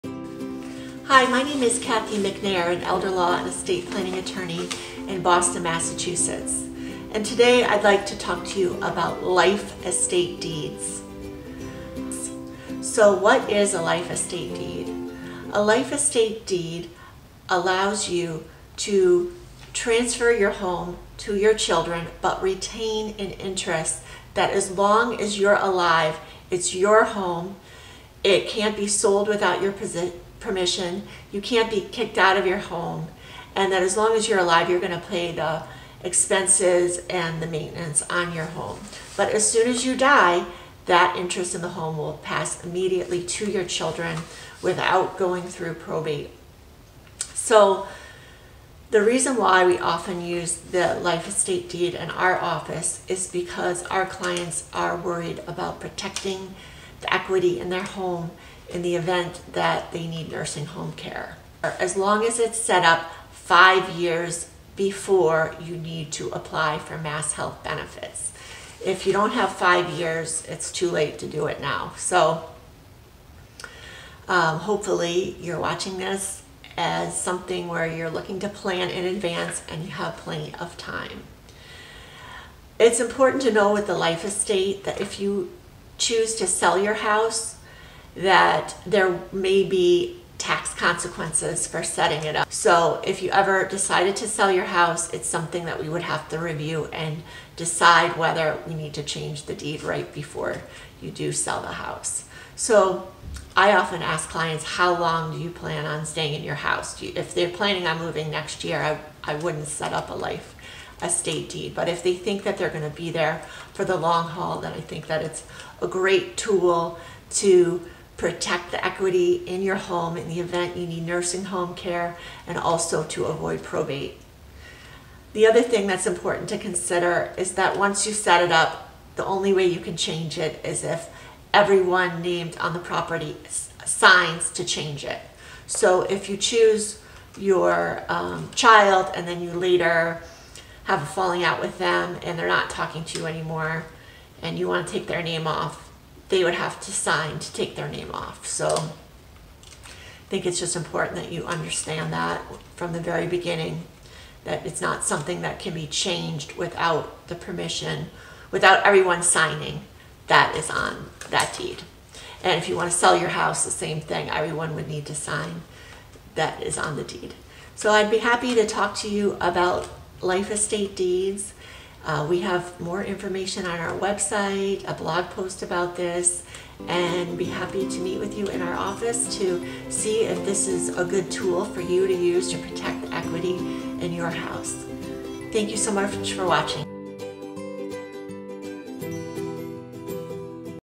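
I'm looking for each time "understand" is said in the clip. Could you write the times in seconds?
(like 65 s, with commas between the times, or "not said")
151 s.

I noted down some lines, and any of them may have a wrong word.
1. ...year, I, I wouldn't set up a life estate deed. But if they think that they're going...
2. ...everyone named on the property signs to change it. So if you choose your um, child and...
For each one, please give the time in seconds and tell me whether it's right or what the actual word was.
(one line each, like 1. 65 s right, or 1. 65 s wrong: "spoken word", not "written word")
1. 108 s right
2. 131 s right.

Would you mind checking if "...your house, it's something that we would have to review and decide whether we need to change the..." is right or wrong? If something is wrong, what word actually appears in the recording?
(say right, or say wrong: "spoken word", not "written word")
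right.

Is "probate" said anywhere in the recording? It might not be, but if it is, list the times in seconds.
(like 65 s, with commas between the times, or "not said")
45 s, 123 s.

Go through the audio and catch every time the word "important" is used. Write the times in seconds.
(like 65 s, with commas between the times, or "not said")
82 s, 126 s, 150 s.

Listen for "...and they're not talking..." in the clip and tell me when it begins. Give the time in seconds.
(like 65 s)
142 s.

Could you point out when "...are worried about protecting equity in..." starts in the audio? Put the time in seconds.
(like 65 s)
54 s.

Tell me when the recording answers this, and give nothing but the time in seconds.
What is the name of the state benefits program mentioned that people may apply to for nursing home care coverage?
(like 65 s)
66 s.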